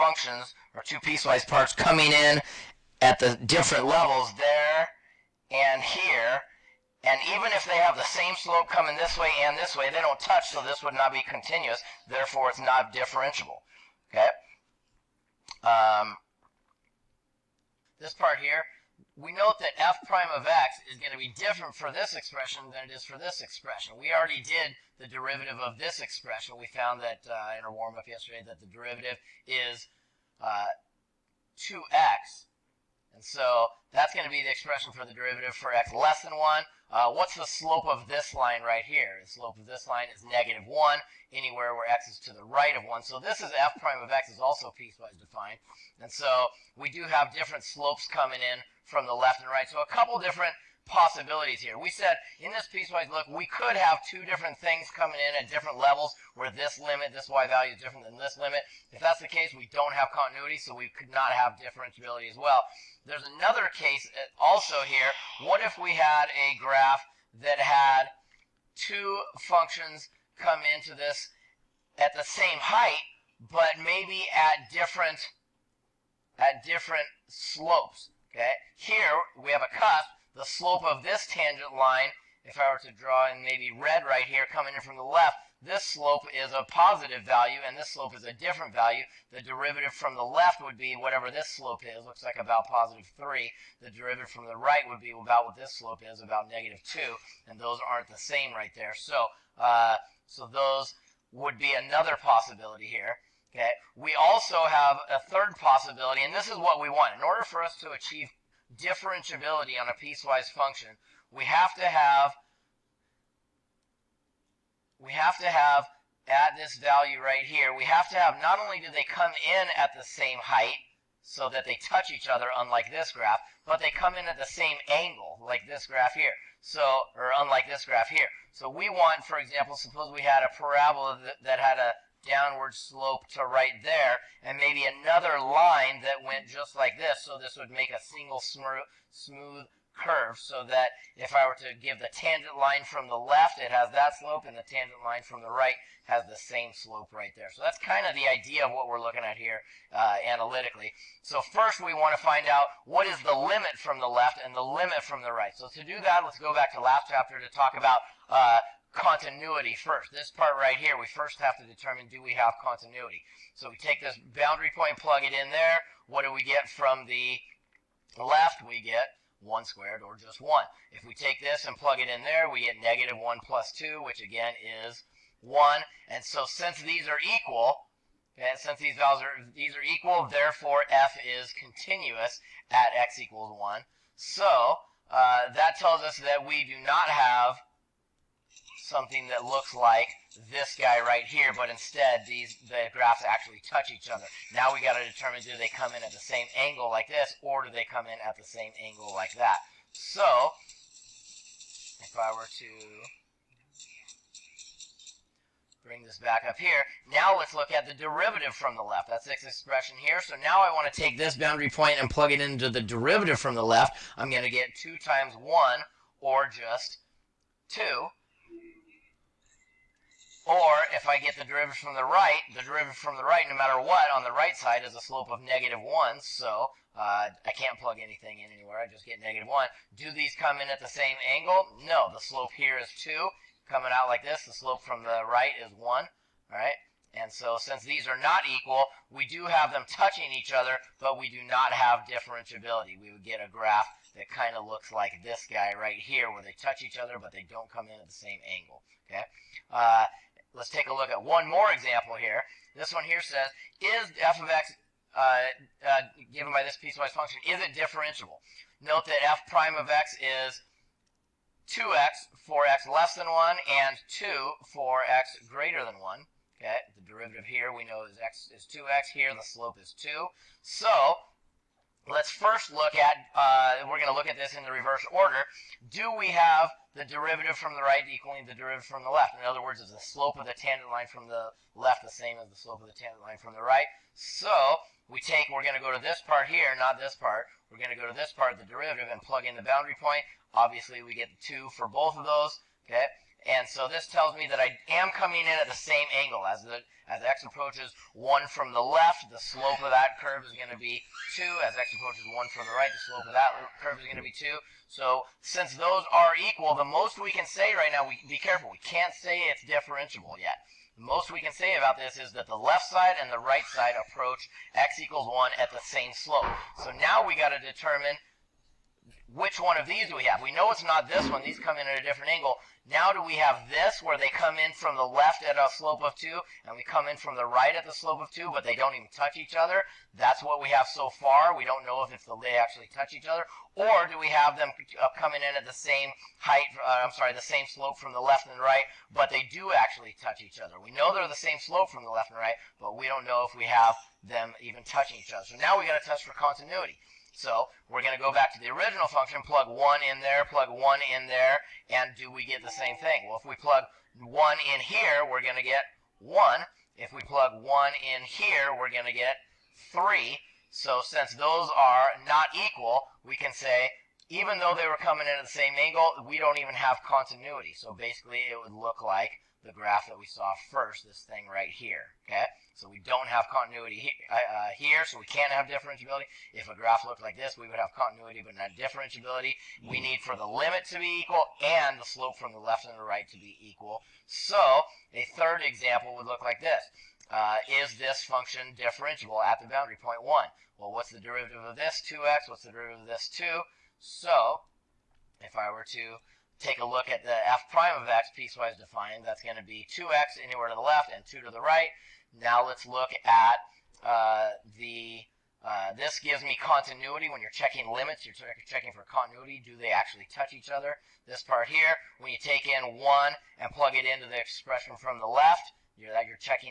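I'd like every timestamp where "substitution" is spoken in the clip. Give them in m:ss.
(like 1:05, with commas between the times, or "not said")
not said.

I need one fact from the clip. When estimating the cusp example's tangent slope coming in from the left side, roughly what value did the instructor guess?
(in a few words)
3.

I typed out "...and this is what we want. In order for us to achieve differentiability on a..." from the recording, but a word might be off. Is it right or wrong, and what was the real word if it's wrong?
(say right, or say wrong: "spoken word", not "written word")
right.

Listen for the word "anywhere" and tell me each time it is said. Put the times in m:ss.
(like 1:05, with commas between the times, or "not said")
0:41, 3:48, 6:40.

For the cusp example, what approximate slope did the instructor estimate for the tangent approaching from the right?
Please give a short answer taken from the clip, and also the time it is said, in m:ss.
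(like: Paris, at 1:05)
-2, at 1:36.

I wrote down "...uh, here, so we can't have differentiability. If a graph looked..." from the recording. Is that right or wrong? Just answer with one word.
right.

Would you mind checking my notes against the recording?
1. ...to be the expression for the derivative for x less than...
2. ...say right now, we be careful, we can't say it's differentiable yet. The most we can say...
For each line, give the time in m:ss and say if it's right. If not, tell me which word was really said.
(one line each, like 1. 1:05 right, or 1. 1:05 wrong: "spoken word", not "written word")
1. 0:34 right
2. 5:07 right.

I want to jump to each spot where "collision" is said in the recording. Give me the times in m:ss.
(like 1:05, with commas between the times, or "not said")
not said.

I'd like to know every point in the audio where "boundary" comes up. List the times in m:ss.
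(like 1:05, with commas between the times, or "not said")
2:44, 3:31, 4:49, 6:29.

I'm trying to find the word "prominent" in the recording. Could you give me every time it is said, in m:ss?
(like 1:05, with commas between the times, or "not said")
not said.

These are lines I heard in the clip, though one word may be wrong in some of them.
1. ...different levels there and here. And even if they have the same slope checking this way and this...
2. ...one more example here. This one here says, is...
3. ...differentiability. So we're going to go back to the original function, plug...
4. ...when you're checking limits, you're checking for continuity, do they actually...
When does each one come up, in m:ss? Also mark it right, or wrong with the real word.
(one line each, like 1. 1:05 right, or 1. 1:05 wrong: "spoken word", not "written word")
1. 0:03 wrong: "coming", not "checking"
2. 4:11 right
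3. 5:46 wrong: "continuity", not "differentiability"
4. 6:47 right.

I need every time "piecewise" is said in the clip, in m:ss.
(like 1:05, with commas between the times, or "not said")
0:00, 0:44, 0:52, 1:49, 4:16, 6:38.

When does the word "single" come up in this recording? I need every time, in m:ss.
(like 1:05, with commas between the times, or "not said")
2:18.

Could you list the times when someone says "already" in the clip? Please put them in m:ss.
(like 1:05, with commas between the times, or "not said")
0:24.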